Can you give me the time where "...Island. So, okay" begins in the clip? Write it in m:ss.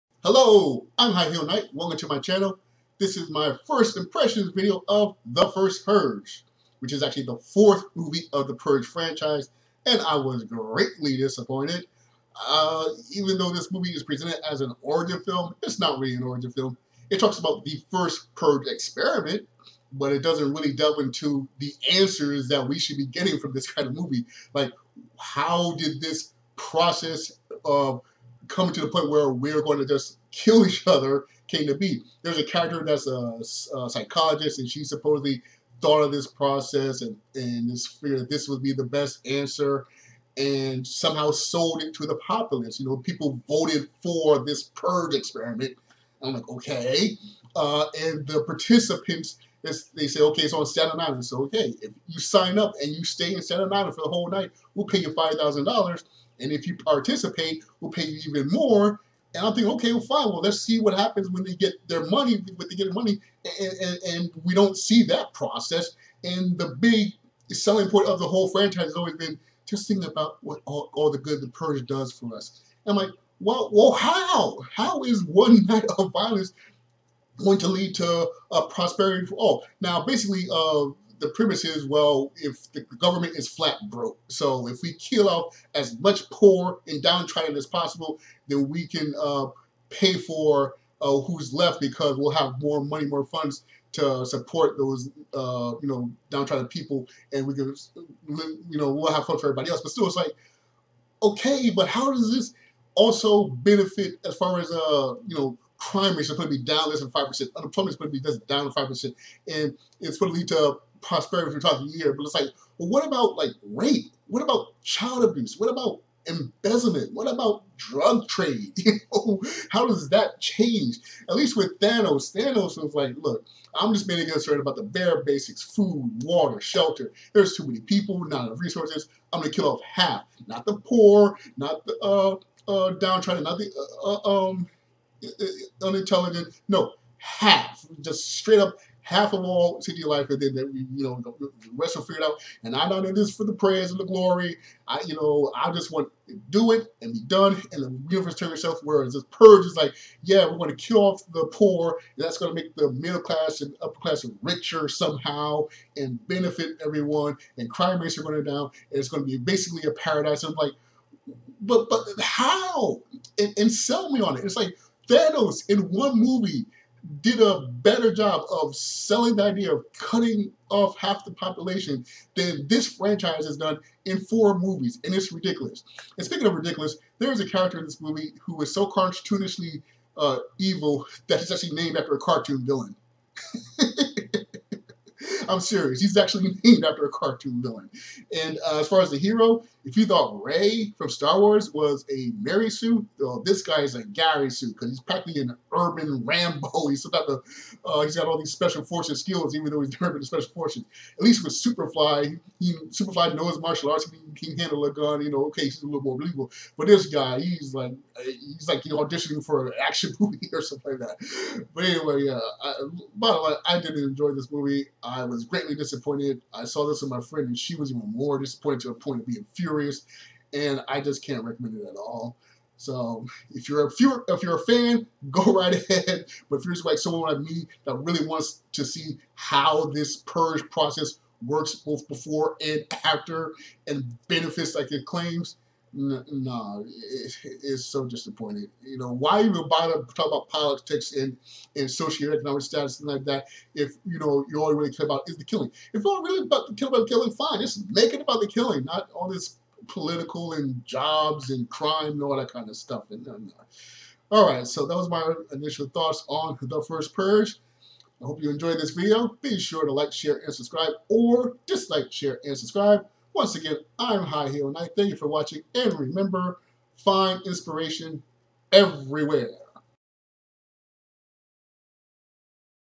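0:50.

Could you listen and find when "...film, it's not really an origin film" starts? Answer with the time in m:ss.
0:15.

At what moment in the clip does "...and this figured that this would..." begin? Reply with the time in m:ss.
0:37.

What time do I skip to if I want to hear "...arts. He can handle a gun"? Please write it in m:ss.
3:23.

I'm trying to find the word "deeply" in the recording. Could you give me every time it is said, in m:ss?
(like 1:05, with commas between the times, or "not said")
not said.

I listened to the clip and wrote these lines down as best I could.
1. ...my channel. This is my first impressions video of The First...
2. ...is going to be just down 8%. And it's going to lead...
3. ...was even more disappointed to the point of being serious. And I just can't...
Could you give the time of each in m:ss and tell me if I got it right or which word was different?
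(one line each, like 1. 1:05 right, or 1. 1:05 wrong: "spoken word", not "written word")
1. 0:02 right
2. 1:47 wrong: "5", not "8"
3. 3:37 wrong: "furious", not "serious".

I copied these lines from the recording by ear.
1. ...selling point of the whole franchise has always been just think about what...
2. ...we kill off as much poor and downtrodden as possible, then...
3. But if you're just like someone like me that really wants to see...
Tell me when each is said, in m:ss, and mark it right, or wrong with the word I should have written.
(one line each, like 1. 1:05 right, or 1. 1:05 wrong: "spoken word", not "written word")
1. 1:07 right
2. 1:24 right
3. 3:46 right.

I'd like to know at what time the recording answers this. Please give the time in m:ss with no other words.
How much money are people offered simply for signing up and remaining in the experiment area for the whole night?
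0:55.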